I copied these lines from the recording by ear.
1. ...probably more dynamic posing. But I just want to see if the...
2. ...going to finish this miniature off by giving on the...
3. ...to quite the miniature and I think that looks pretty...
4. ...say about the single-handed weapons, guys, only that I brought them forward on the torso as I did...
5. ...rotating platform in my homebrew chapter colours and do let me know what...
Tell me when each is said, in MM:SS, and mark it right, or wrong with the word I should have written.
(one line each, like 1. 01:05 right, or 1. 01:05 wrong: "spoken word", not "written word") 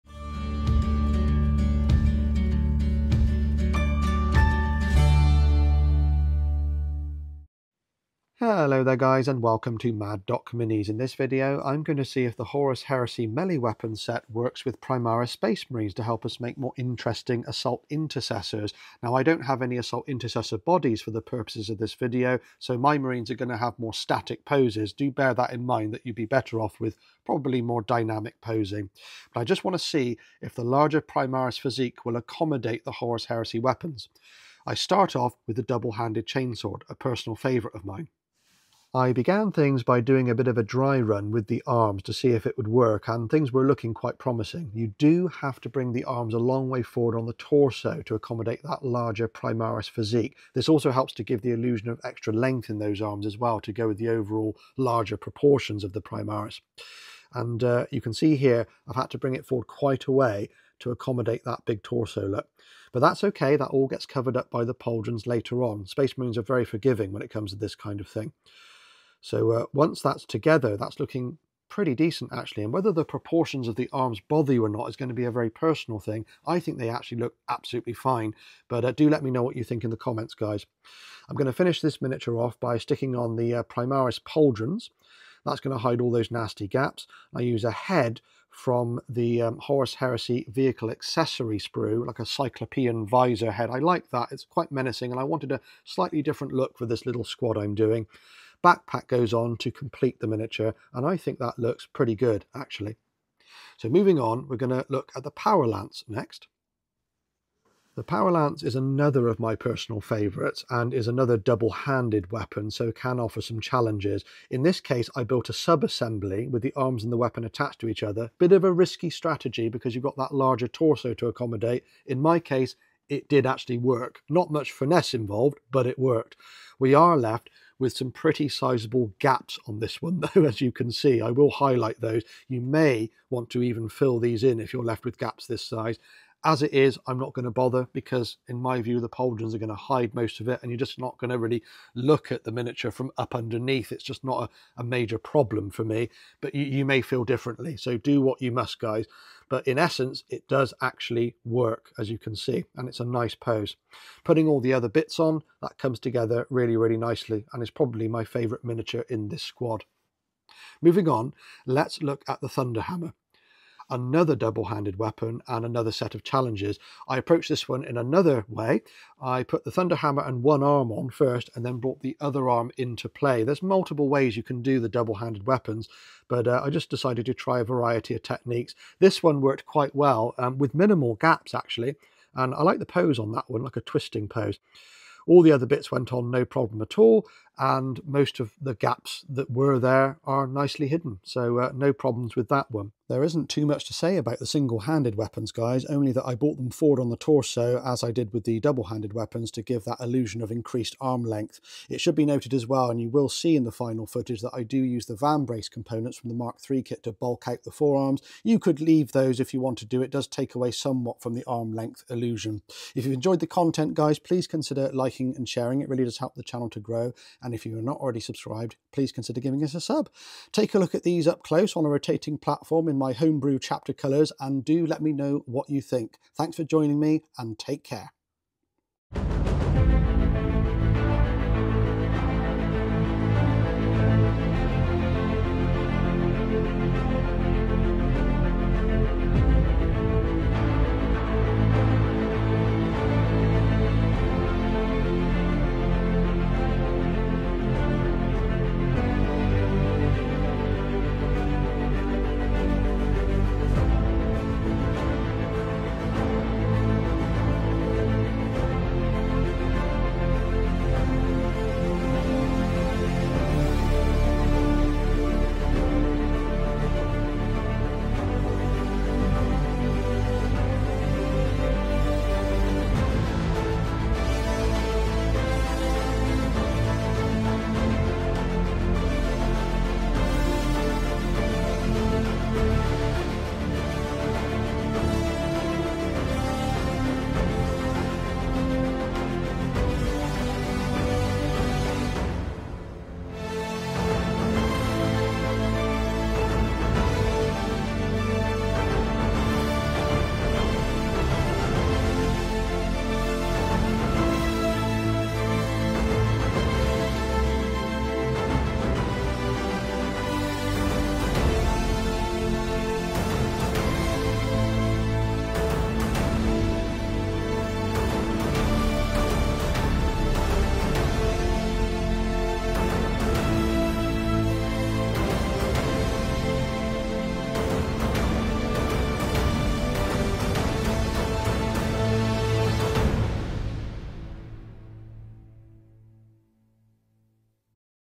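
1. 00:27 right
2. 01:21 wrong: "sticking", not "giving"
3. 01:39 wrong: "complete", not "quite"
4. 03:13 right
5. 03:41 right.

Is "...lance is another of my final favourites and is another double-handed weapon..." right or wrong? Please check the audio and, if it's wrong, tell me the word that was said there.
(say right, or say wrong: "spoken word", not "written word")
wrong: "personal", not "final".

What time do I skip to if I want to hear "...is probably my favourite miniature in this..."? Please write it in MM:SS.
02:37.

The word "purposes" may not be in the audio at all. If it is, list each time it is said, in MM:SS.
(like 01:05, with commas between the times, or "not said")
00:21.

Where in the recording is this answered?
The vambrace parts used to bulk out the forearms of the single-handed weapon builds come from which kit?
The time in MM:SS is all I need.
03:26.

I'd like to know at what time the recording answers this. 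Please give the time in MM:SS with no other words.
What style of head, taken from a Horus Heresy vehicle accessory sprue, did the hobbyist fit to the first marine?
01:32.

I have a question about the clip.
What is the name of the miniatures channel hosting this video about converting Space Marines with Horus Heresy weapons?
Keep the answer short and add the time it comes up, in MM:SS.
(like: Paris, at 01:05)
Mad Dok Minis, at 00:09.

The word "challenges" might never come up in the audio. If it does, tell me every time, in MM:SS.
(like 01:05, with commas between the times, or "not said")
01:53, 02:46.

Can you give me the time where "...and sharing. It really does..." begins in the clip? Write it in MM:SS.
03:35.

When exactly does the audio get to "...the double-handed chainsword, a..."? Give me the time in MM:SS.
00:35.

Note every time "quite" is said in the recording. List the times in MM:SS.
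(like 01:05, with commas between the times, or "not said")
00:43, 00:59, 01:34, 02:59.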